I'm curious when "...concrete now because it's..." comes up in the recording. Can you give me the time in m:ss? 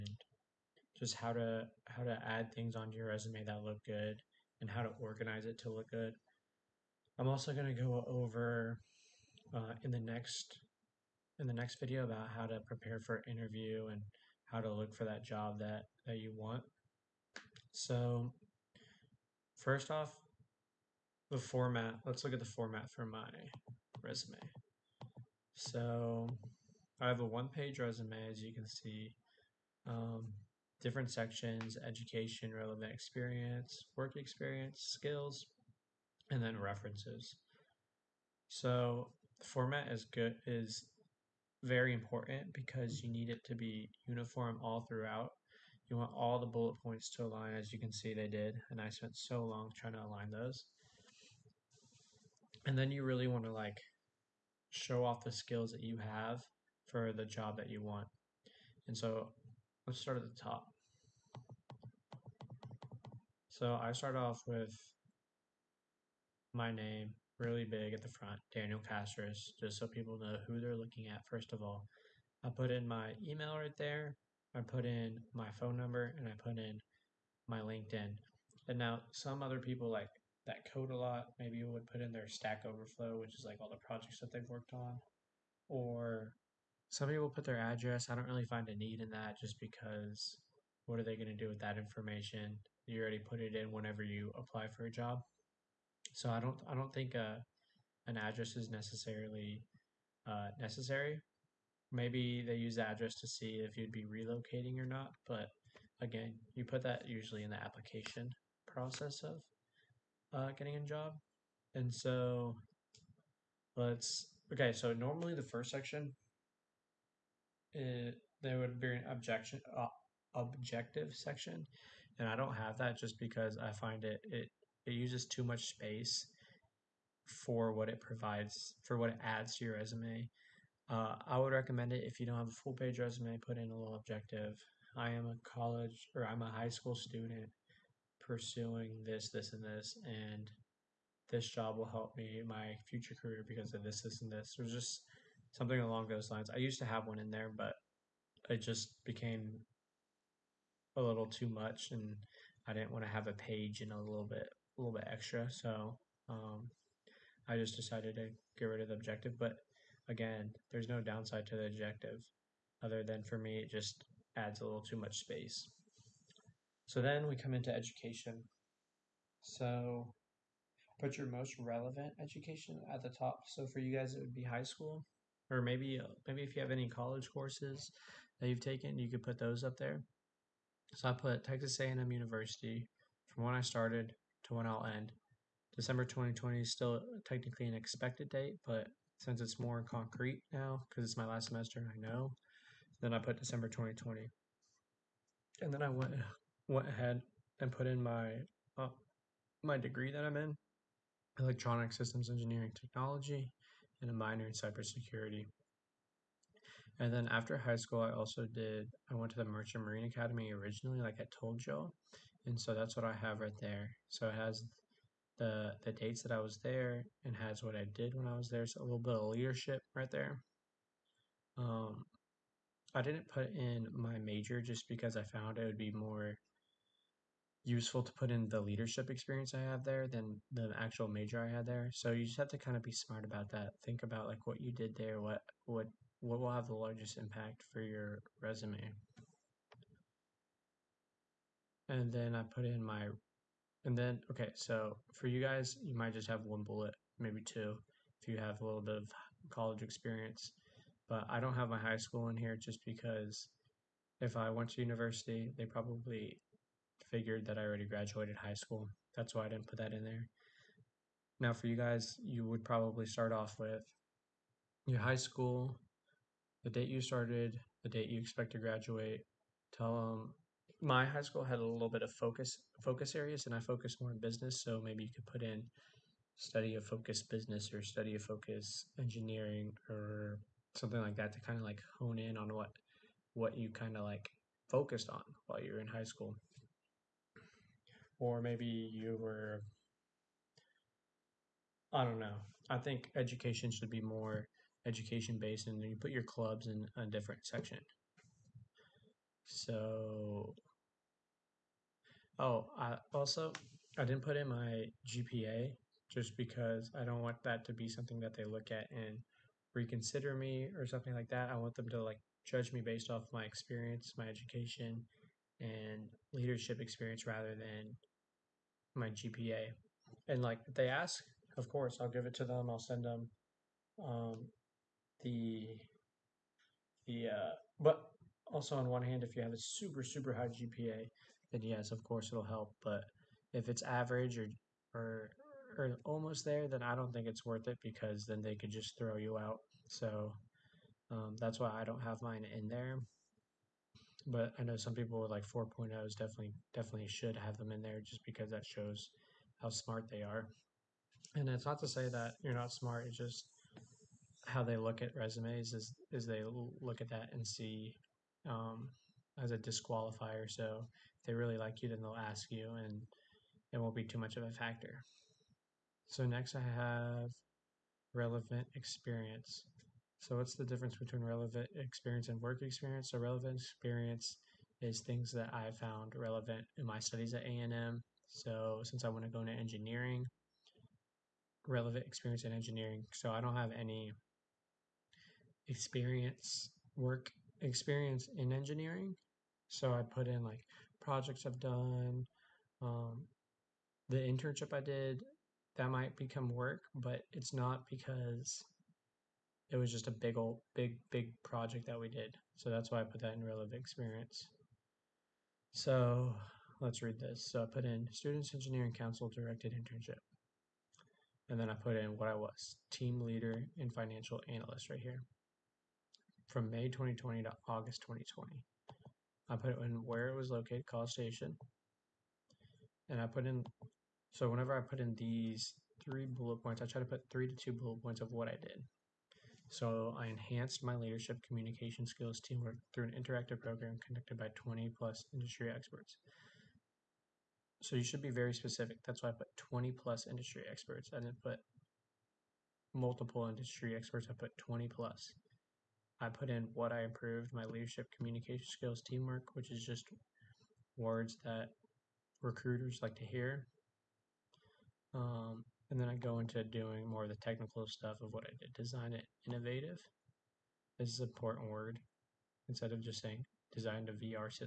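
3:09.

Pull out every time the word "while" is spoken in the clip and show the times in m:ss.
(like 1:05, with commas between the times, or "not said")
4:45.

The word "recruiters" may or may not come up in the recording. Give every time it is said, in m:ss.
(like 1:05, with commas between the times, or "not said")
7:32.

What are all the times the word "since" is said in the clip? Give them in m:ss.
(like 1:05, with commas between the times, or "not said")
3:09, 6:18.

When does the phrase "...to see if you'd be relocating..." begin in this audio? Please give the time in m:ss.
1:43.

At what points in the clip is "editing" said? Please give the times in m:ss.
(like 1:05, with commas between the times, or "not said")
not said.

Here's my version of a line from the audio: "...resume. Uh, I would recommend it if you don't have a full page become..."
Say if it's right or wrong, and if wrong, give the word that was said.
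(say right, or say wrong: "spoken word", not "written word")
wrong: "resume", not "become".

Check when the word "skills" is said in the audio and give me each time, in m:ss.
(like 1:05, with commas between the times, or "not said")
0:34, 0:55, 7:12, 7:28.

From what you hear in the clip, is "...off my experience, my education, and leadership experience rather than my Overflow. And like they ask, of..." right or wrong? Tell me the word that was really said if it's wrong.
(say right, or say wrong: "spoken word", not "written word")
wrong: "GPA", not "Overflow".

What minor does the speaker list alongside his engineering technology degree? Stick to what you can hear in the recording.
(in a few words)
Cybersecurity.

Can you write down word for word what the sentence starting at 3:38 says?
So a little bit of leadership right there.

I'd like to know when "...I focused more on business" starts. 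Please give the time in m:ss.
4:33.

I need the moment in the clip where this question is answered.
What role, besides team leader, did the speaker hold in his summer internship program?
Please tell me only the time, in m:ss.
6:53.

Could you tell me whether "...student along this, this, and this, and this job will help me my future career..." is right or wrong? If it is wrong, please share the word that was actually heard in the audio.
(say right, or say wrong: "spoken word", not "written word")
wrong: "pursuing", not "along".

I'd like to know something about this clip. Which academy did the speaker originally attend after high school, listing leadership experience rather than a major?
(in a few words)
Merchant Marine Academy.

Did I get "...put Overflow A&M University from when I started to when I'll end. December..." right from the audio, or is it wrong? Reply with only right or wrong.
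wrong.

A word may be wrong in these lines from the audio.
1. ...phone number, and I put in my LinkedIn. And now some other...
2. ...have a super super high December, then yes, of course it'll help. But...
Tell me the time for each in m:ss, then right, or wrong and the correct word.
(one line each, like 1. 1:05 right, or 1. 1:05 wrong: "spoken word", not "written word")
1. 1:15 right
2. 5:29 wrong: "GPA", not "December".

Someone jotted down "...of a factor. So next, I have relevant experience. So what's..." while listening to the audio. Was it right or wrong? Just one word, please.
right.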